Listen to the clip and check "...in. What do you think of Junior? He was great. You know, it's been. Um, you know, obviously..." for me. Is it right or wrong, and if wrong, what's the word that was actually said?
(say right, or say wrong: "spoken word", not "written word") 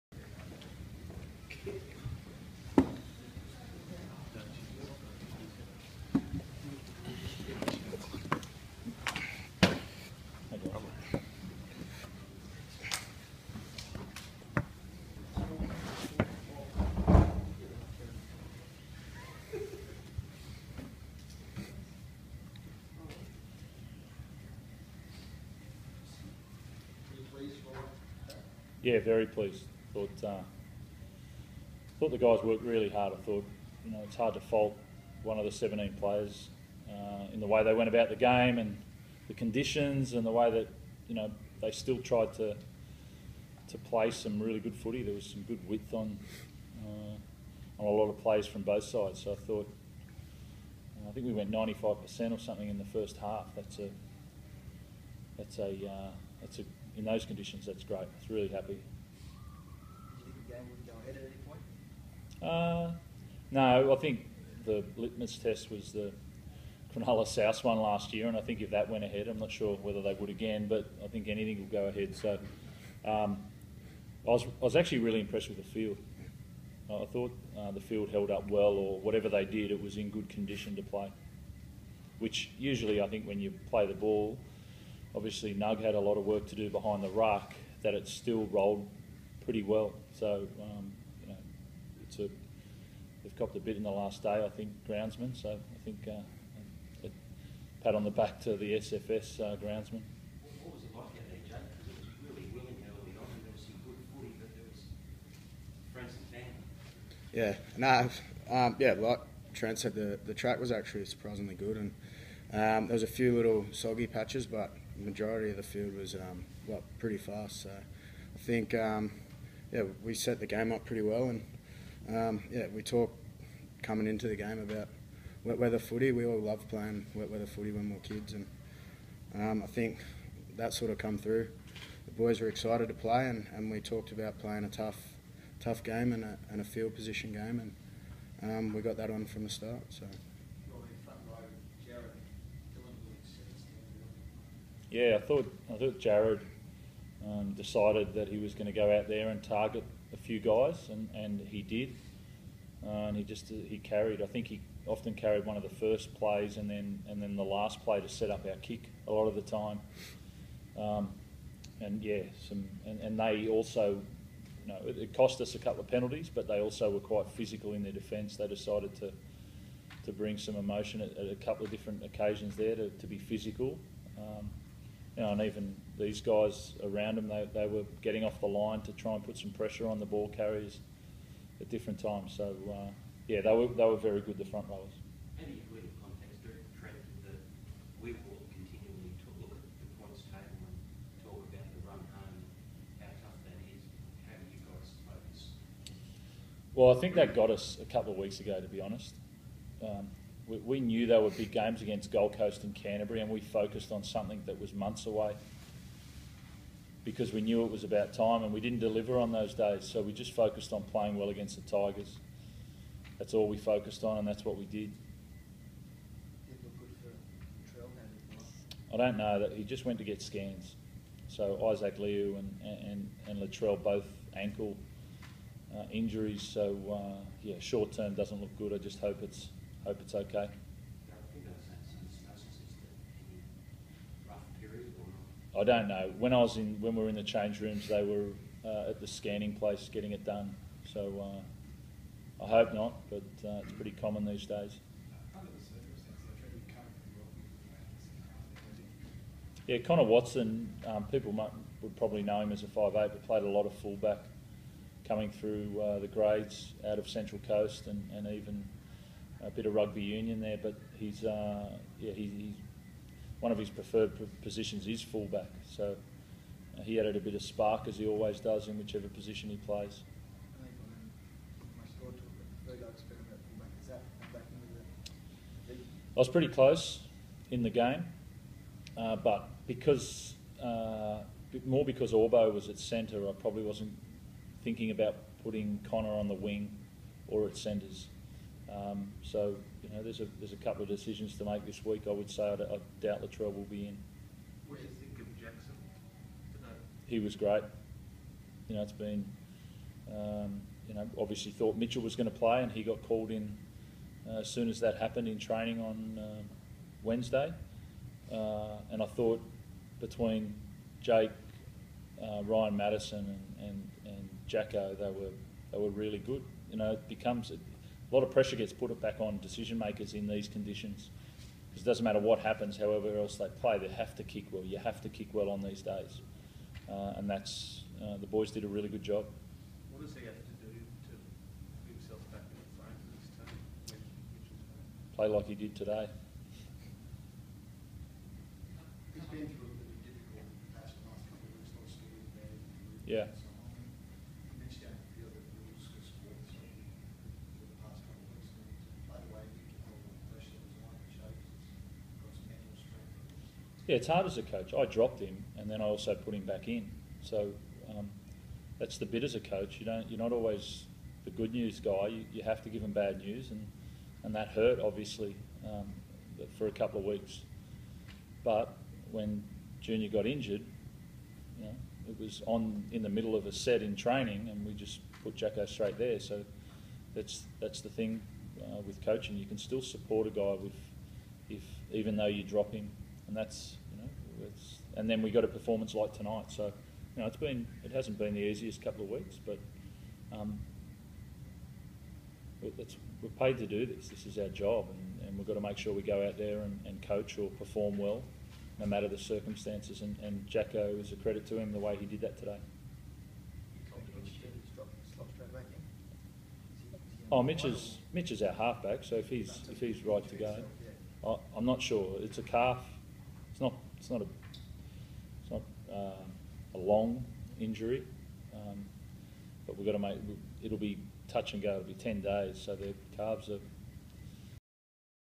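wrong: "Jackson", not "Junior".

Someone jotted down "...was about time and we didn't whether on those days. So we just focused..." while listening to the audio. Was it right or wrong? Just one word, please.
wrong.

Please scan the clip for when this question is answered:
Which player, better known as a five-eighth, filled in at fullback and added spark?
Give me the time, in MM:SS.
04:09.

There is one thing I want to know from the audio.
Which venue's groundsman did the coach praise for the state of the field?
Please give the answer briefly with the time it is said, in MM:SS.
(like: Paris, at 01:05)
SFS, at 01:38.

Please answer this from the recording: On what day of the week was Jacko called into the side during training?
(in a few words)
Wednesday.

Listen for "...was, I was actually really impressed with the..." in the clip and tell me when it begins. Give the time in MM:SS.
01:14.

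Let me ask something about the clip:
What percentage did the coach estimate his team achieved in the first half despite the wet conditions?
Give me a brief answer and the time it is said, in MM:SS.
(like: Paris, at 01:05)
95%, at 00:51.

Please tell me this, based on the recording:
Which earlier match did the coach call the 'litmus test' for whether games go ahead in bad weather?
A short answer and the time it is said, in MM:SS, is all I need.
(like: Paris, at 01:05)
Cronulla South, at 01:06.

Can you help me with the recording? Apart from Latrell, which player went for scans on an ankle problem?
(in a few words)
Isaac Liu.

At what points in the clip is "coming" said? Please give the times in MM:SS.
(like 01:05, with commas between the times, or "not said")
02:03, 04:15.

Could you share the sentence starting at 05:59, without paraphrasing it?
You don't, you're not always the good news guy.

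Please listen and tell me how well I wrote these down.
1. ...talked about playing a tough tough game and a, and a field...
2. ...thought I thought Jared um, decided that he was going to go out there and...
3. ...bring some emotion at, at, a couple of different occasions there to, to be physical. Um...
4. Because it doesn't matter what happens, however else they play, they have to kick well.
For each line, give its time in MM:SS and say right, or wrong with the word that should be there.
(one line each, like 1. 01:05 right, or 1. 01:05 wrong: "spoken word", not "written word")
1. 02:13 right
2. 02:25 right
3. 02:50 right
4. 05:21 right.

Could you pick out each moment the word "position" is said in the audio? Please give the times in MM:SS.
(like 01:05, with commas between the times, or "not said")
02:16, 04:24, 04:29.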